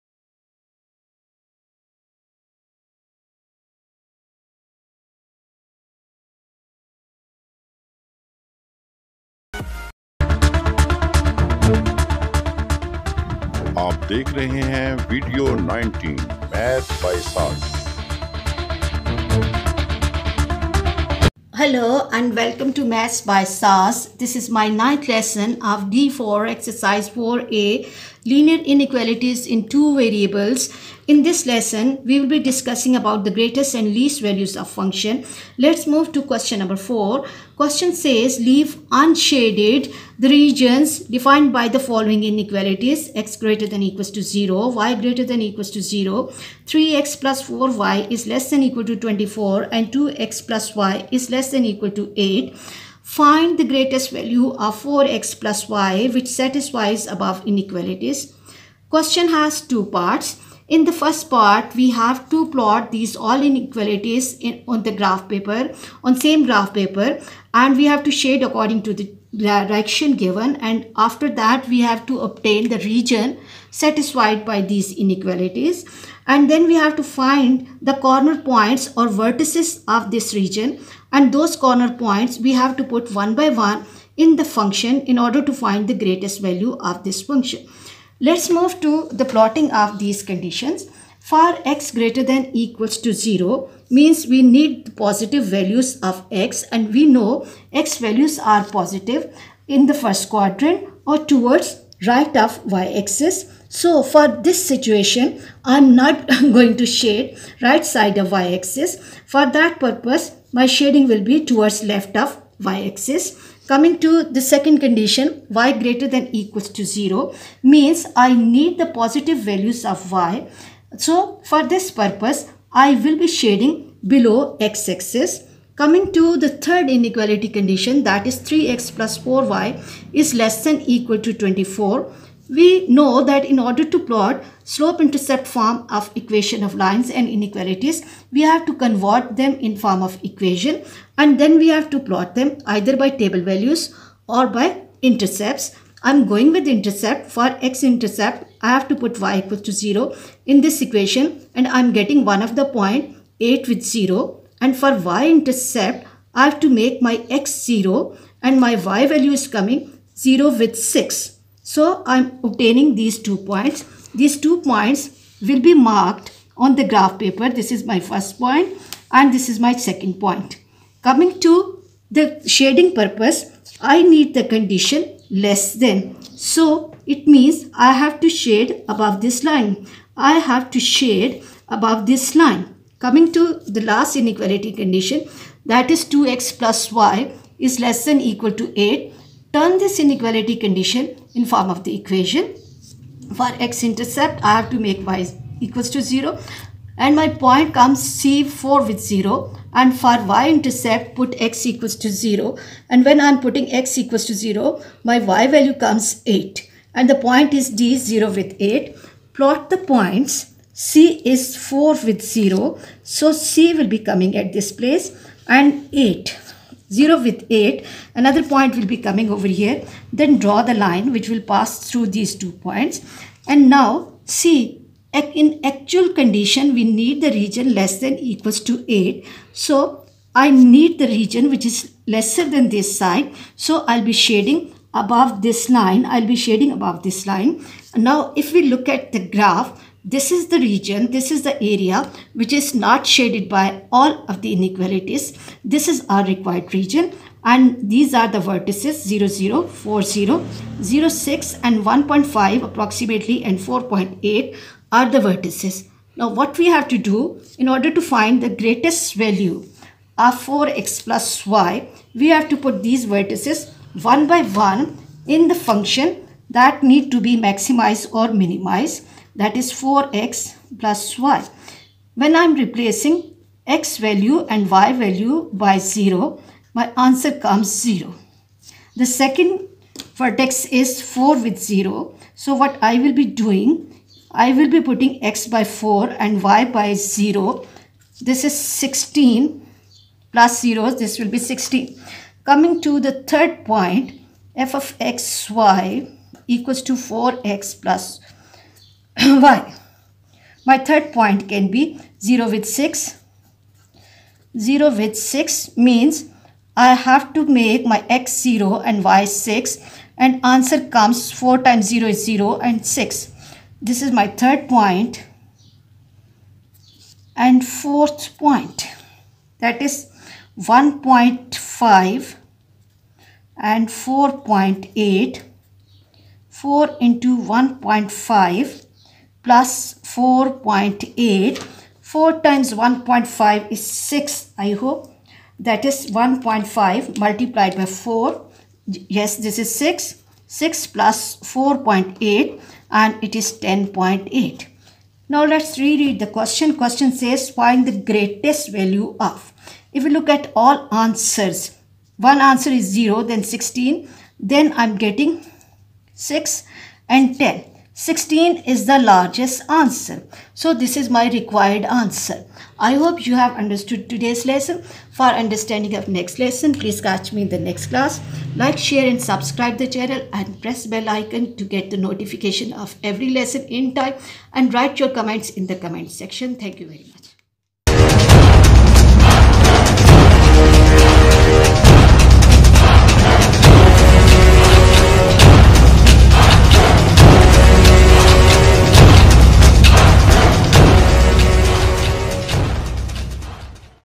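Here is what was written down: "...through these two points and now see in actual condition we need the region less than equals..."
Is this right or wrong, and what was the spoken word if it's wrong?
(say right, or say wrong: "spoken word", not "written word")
right.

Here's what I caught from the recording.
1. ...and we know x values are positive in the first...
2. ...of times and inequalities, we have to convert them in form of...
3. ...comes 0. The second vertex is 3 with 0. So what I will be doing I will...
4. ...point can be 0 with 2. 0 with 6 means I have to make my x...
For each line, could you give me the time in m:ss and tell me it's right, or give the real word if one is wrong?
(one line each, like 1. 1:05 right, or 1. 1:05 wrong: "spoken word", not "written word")
1. 1:36 right
2. 2:16 wrong: "lines", not "times"
3. 4:37 wrong: "4", not "3"
4. 5:01 wrong: "6", not "2".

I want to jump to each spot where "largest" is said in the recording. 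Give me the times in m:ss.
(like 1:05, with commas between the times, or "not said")
5:58.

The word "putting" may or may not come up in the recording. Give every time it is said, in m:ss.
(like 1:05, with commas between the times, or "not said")
3:23, 4:44.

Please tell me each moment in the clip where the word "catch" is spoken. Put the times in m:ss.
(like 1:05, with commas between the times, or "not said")
6:06.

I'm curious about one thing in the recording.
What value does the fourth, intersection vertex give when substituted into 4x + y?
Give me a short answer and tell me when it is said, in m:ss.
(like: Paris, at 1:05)
10.8, at 5:43.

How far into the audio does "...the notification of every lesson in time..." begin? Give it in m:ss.
6:11.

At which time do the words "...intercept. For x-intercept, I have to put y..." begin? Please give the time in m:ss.
2:26.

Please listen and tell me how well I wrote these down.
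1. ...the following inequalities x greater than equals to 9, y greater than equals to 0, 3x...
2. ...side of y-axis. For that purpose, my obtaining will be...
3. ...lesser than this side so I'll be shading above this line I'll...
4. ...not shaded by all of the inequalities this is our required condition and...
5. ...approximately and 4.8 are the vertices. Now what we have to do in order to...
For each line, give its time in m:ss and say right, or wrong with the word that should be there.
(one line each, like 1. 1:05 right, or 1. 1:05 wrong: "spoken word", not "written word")
1. 0:41 wrong: "0", not "9"
2. 1:47 wrong: "shading", not "obtaining"
3. 3:52 right
4. 4:02 wrong: "region", not "condition"
5. 4:12 right.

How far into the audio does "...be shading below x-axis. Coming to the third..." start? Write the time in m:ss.
2:03.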